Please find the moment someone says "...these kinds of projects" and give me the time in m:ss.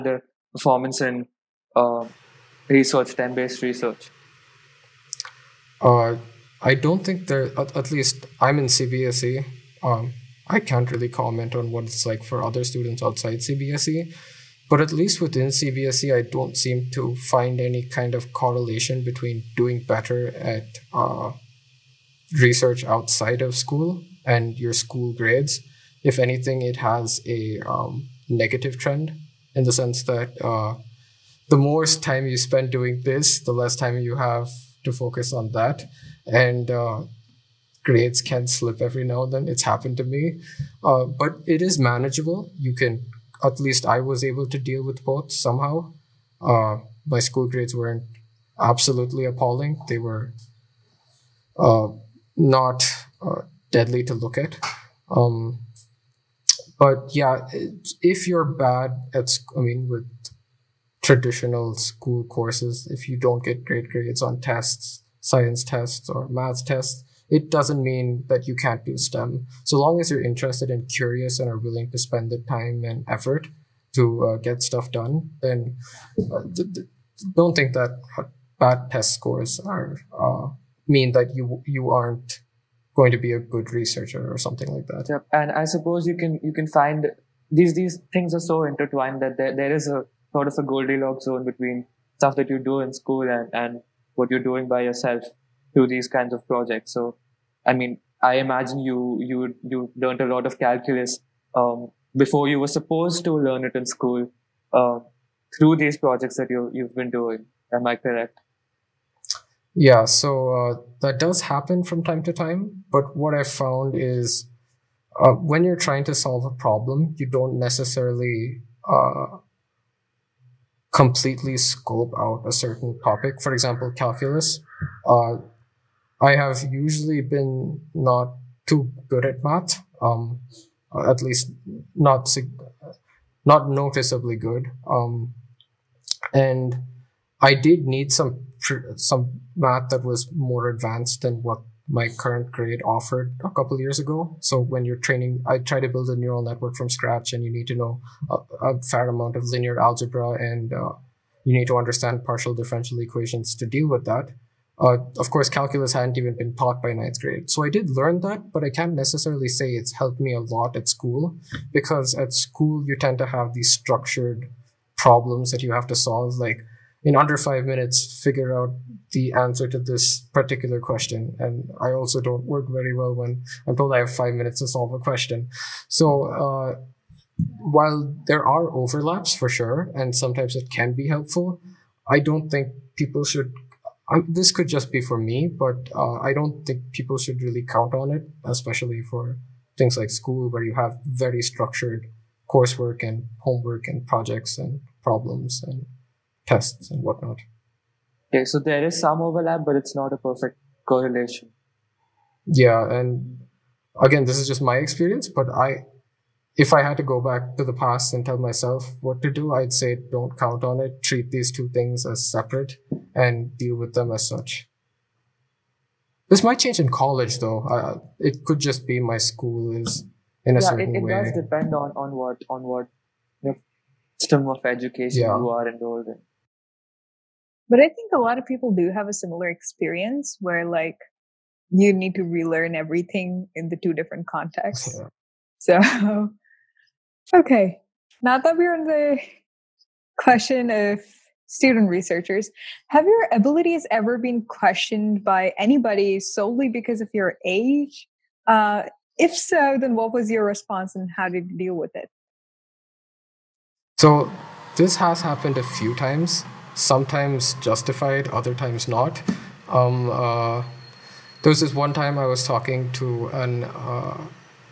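1:35.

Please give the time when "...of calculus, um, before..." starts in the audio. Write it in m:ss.
1:40.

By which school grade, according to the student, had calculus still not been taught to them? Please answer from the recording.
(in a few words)
ninth grade.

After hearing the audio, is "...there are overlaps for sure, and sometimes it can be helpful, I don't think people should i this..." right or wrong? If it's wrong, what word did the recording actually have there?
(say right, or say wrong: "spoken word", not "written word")
right.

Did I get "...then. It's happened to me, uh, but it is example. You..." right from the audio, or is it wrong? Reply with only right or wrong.
wrong.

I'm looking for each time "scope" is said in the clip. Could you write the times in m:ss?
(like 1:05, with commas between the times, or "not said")
2:01.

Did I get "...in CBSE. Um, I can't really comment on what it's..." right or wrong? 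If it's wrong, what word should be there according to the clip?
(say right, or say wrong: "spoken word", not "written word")
right.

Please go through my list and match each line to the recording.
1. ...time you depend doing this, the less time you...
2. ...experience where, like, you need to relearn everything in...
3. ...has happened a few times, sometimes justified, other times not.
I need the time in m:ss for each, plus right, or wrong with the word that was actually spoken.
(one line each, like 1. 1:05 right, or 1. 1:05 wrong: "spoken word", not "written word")
1. 0:31 wrong: "spend", not "depend"
2. 3:49 right
3. 4:14 right.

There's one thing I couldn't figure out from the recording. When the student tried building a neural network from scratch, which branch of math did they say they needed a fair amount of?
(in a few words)
linear algebra.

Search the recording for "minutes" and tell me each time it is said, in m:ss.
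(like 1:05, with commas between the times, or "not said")
2:47, 2:54.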